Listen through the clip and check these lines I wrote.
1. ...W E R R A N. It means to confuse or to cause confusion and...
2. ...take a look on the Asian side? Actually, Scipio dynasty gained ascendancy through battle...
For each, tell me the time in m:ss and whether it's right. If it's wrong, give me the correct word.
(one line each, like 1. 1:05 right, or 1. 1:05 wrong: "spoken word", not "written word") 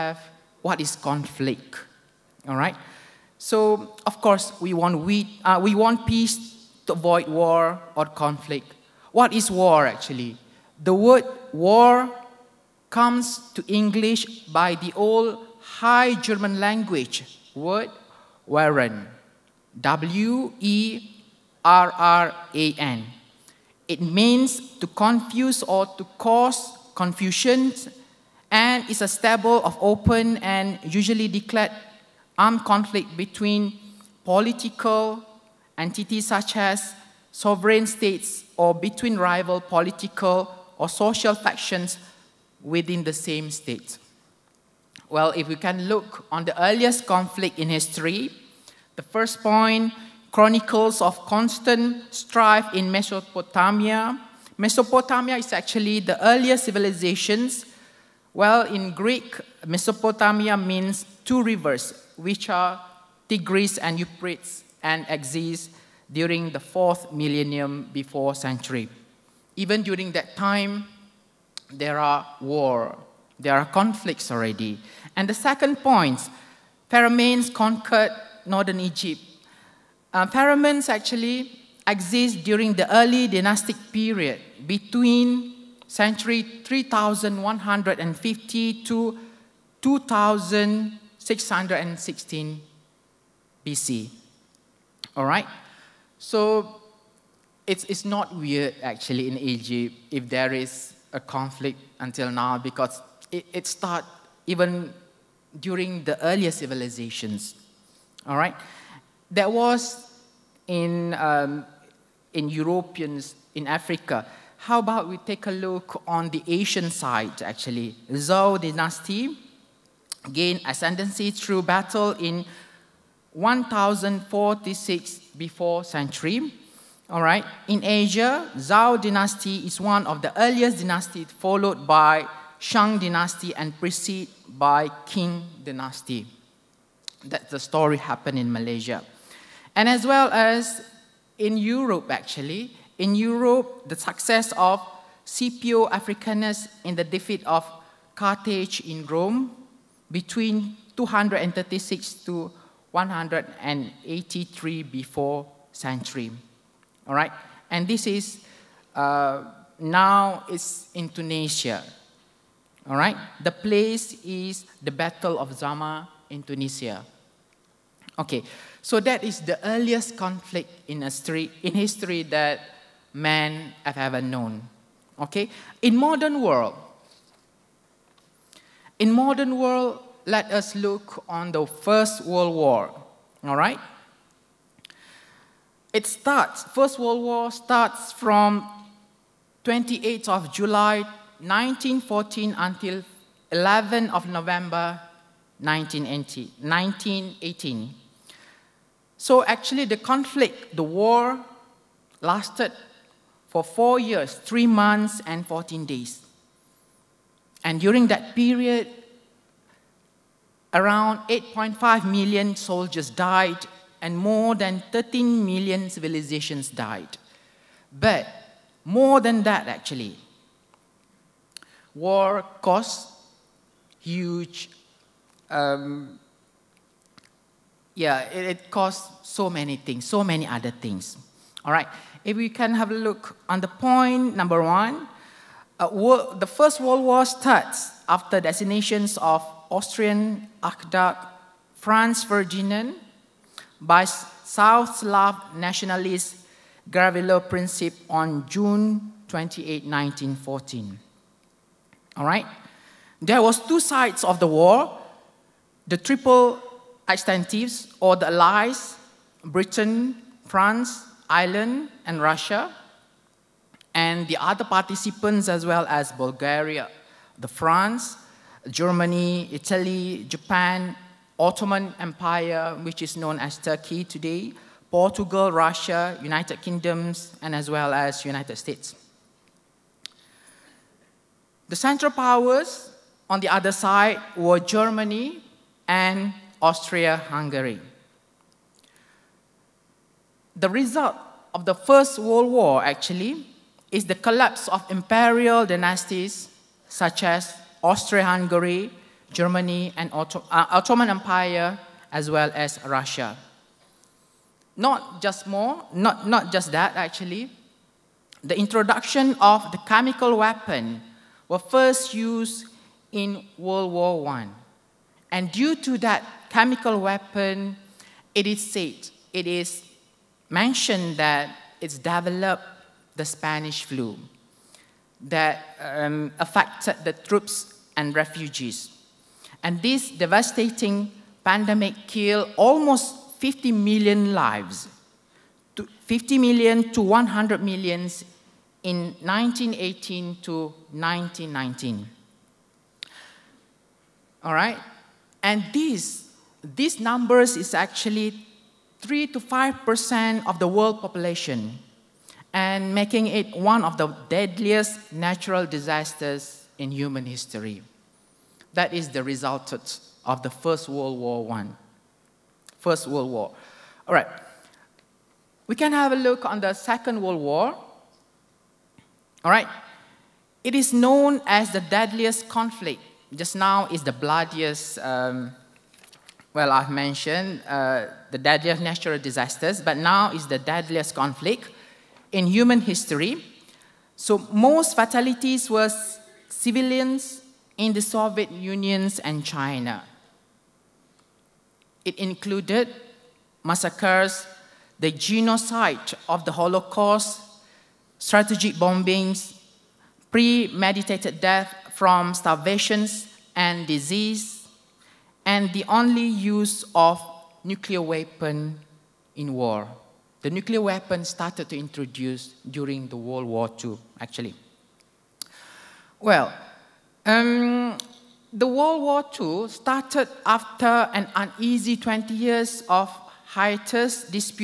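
1. 0:19 right
2. 1:55 wrong: "Zhou", not "Scipio".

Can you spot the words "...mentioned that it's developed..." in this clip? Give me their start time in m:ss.
5:20.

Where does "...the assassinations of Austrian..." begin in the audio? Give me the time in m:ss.
3:58.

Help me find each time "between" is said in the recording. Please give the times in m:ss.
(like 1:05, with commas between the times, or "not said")
0:33, 0:38, 1:24, 2:30.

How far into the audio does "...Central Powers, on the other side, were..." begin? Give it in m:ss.
4:41.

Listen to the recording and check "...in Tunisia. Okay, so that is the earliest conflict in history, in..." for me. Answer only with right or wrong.
right.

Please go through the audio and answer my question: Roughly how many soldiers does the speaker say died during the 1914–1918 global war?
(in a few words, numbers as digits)
8.5 million.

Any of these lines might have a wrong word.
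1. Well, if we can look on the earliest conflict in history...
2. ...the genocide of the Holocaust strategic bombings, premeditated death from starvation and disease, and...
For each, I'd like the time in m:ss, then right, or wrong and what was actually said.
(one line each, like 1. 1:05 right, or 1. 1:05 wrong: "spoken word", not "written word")
1. 0:45 right
2. 6:34 right.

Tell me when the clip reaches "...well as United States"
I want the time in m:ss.
4:37.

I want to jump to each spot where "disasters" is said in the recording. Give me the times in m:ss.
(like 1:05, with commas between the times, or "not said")
5:55, 6:19.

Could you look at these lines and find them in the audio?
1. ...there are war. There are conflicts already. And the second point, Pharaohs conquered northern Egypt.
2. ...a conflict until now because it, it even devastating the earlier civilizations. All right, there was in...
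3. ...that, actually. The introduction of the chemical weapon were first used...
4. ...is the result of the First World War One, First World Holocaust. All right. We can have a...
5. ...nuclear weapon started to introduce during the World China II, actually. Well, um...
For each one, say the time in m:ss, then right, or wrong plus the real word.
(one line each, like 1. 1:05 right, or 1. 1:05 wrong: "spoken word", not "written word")
1. 1:11 right
2. 1:41 wrong: "during", not "devastating"
3. 5:06 right
4. 5:58 wrong: "War", not "Holocaust"
5. 6:50 wrong: "War", not "China".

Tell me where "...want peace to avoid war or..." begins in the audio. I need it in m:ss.
0:05.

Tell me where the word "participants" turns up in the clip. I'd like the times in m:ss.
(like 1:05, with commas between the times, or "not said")
4:24.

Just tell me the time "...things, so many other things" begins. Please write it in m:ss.
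3:49.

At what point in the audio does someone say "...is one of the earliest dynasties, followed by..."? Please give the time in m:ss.
2:09.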